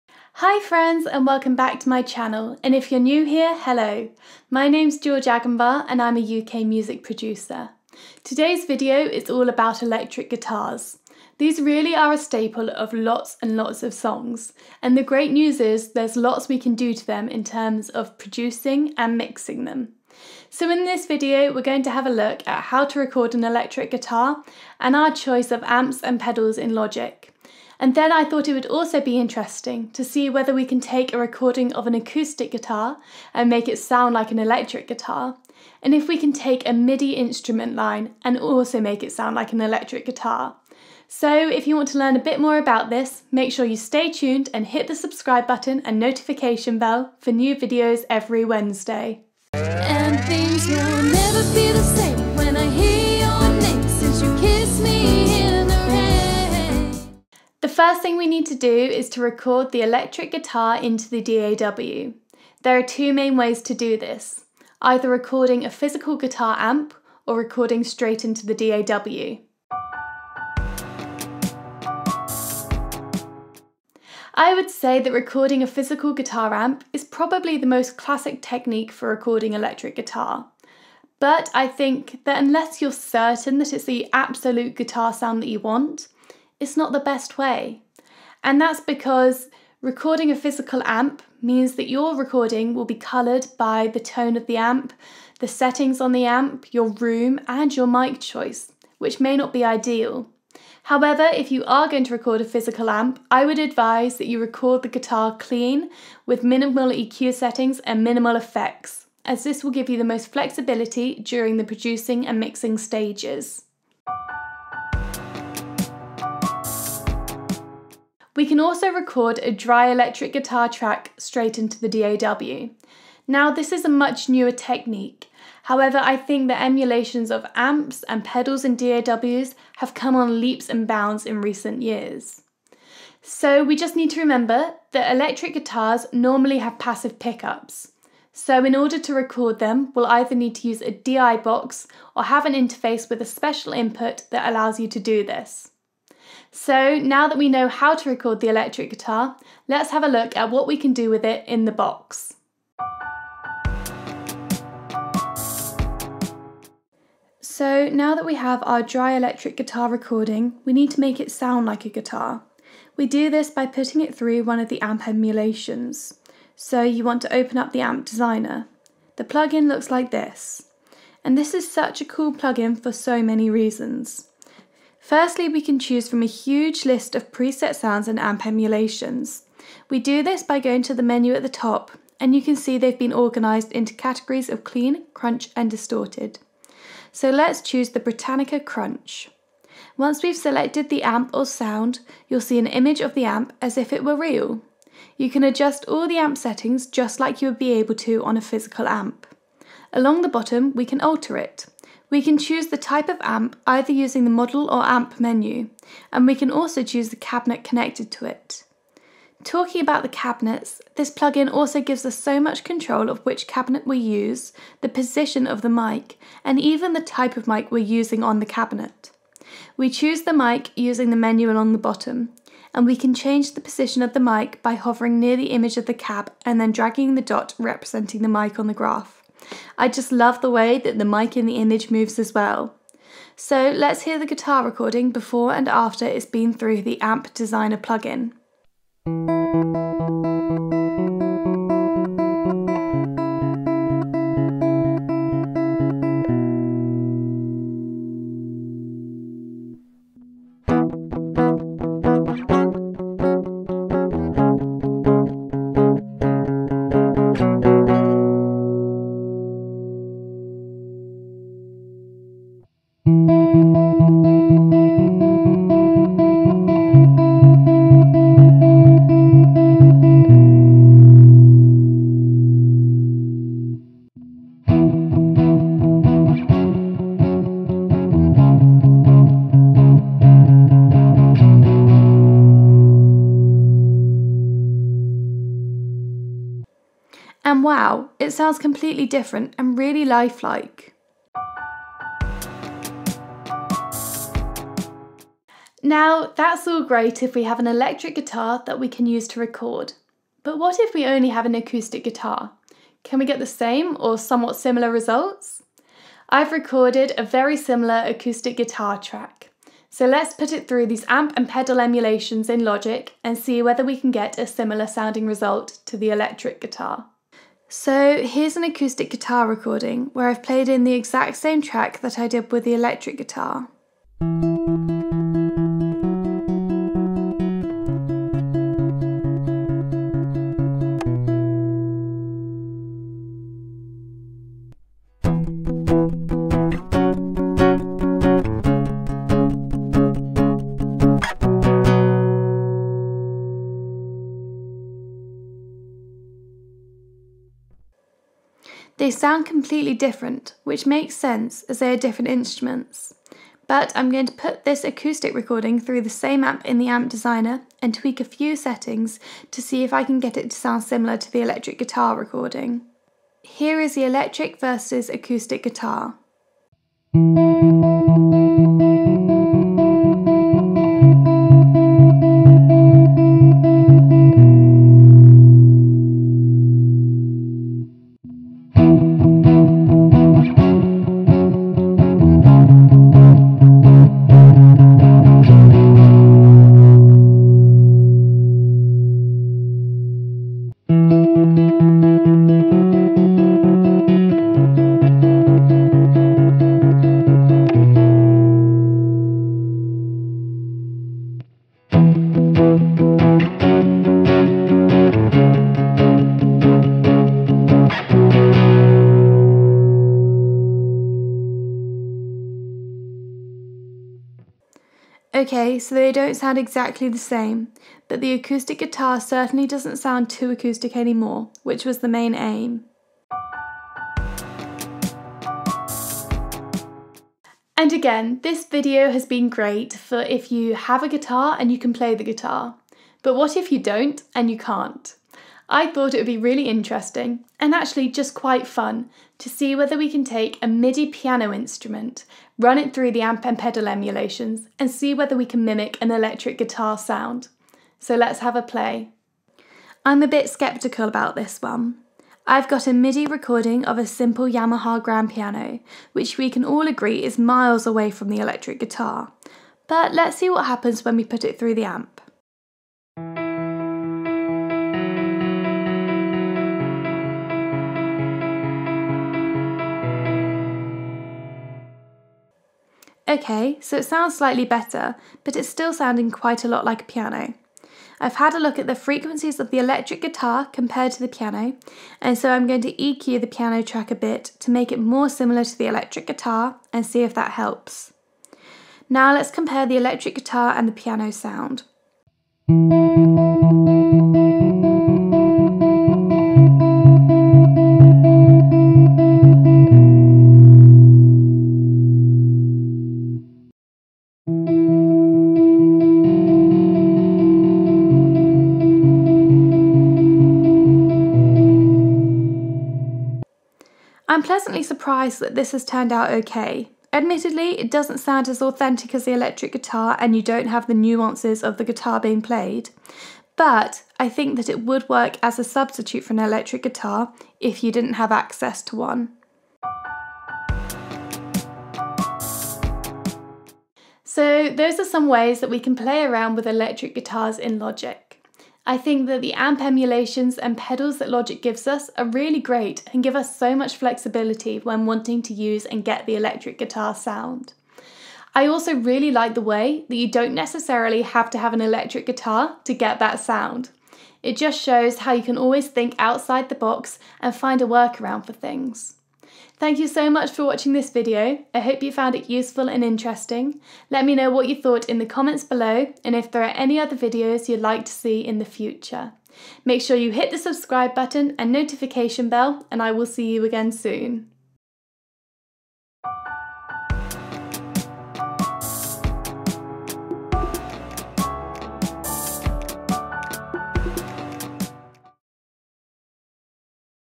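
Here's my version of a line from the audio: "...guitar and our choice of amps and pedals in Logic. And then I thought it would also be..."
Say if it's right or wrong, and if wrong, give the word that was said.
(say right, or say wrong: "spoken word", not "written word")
right.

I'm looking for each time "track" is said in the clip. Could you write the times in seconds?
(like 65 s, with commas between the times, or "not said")
120 s, 308 s, 321 s, 483 s.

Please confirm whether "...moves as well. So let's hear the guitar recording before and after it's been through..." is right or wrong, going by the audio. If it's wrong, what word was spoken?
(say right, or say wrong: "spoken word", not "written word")
right.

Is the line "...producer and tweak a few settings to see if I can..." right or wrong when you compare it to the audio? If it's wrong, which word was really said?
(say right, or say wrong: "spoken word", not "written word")
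wrong: "designer", not "producer".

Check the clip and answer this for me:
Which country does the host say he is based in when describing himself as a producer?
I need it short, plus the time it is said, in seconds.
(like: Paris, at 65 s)
UK, at 6 s.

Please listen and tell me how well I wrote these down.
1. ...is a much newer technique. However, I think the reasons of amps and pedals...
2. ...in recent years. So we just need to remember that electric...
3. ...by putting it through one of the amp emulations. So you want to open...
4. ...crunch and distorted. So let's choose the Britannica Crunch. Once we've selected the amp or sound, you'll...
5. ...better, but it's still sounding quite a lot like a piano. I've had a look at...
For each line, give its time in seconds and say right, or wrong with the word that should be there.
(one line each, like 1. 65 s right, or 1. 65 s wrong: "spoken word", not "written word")
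1. 123 s wrong: "emulations", not "reasons"
2. 131 s right
3. 163 s right
4. 185 s right
5. 474 s right.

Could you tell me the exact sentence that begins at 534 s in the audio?
So, those are some ways that we can play around with electric guitars in Logic.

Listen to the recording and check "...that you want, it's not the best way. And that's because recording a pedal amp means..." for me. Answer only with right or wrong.
wrong.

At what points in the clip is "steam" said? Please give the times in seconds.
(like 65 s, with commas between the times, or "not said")
not said.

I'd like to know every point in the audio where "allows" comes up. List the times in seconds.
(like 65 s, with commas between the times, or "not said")
144 s.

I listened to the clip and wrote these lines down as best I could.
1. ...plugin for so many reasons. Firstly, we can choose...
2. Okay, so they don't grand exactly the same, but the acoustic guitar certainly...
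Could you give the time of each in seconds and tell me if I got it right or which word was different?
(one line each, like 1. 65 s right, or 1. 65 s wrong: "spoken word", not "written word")
1. 172 s right
2. 415 s wrong: "sound", not "grand".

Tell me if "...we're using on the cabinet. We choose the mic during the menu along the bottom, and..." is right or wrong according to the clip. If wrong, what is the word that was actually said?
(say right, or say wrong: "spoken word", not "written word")
wrong: "using", not "during".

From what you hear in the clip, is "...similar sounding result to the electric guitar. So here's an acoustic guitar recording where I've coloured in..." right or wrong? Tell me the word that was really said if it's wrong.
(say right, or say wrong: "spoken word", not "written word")
wrong: "played", not "coloured".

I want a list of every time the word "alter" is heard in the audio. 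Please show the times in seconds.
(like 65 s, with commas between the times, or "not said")
201 s.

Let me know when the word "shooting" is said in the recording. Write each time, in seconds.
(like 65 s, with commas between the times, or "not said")
not said.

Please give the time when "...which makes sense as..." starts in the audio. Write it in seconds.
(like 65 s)
350 s.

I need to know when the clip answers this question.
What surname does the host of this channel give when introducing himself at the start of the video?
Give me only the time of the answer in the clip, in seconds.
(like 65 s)
5 s.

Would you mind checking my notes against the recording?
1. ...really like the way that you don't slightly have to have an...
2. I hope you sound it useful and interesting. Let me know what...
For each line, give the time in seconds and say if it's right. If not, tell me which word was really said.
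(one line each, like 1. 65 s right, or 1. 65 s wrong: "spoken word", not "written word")
1. 548 s wrong: "necessarily", not "slightly"
2. 561 s wrong: "found", not "sound".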